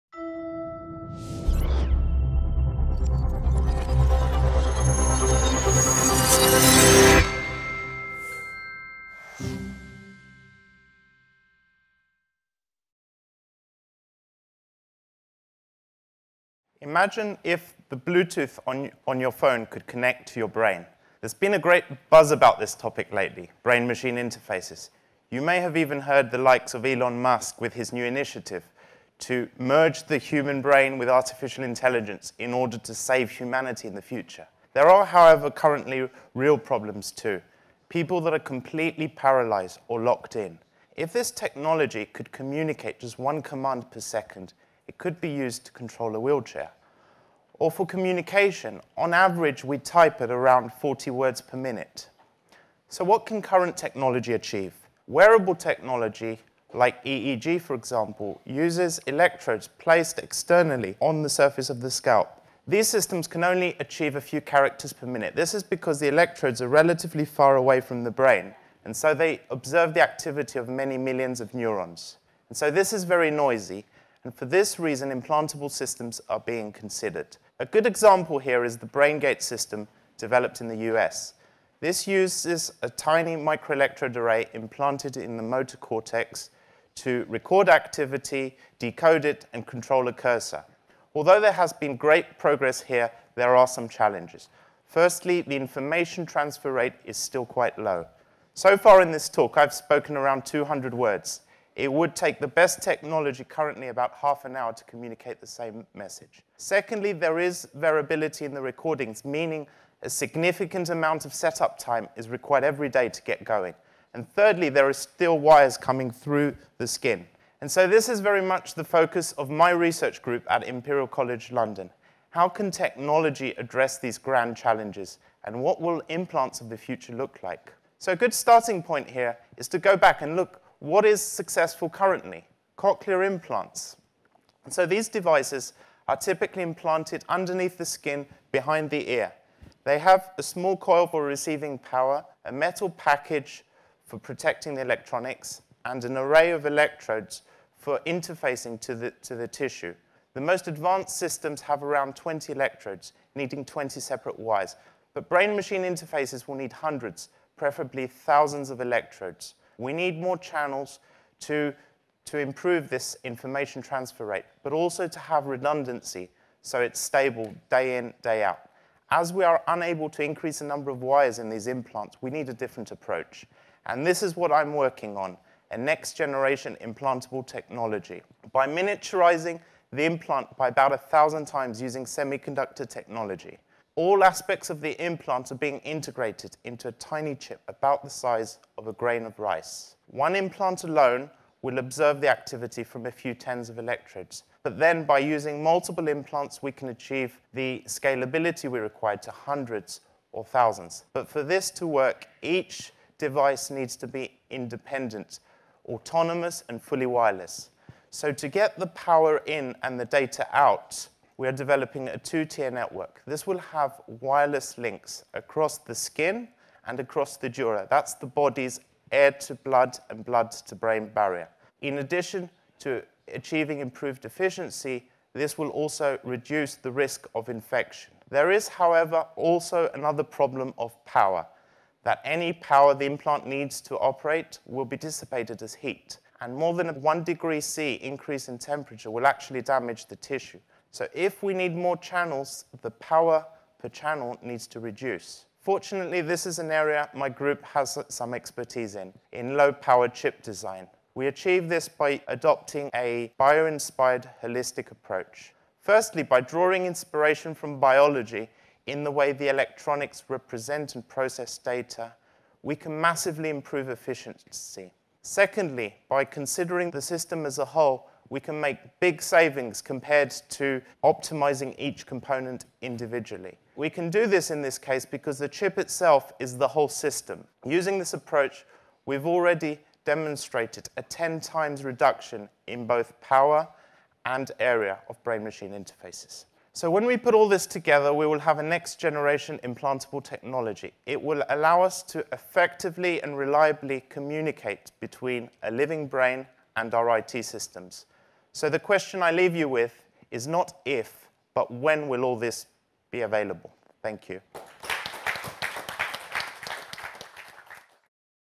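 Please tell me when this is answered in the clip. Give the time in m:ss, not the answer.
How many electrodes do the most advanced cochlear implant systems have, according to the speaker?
2:31.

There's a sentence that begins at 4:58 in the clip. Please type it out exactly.
So the question I leave you with is not if, but when will all this be available?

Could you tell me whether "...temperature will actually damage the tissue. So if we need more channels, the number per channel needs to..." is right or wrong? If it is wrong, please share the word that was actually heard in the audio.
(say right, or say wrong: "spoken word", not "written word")
wrong: "power", not "number".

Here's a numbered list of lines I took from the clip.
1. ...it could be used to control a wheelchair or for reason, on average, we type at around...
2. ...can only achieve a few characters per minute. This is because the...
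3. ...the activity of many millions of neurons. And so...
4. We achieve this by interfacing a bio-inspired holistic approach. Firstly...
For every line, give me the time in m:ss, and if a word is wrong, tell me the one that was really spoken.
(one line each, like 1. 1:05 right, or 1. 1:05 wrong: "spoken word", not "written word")
1. 0:44 wrong: "communication", not "reason"
2. 1:03 right
3. 1:09 right
4. 4:11 wrong: "adopting", not "interfacing".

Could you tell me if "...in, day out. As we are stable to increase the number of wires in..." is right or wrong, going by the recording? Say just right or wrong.
wrong.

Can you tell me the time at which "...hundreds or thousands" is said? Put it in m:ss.
3:19.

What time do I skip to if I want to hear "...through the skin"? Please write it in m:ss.
1:56.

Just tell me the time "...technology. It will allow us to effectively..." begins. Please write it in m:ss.
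4:50.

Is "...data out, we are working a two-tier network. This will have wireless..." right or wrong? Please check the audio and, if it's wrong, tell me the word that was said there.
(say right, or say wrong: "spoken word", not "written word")
wrong: "developing", not "working".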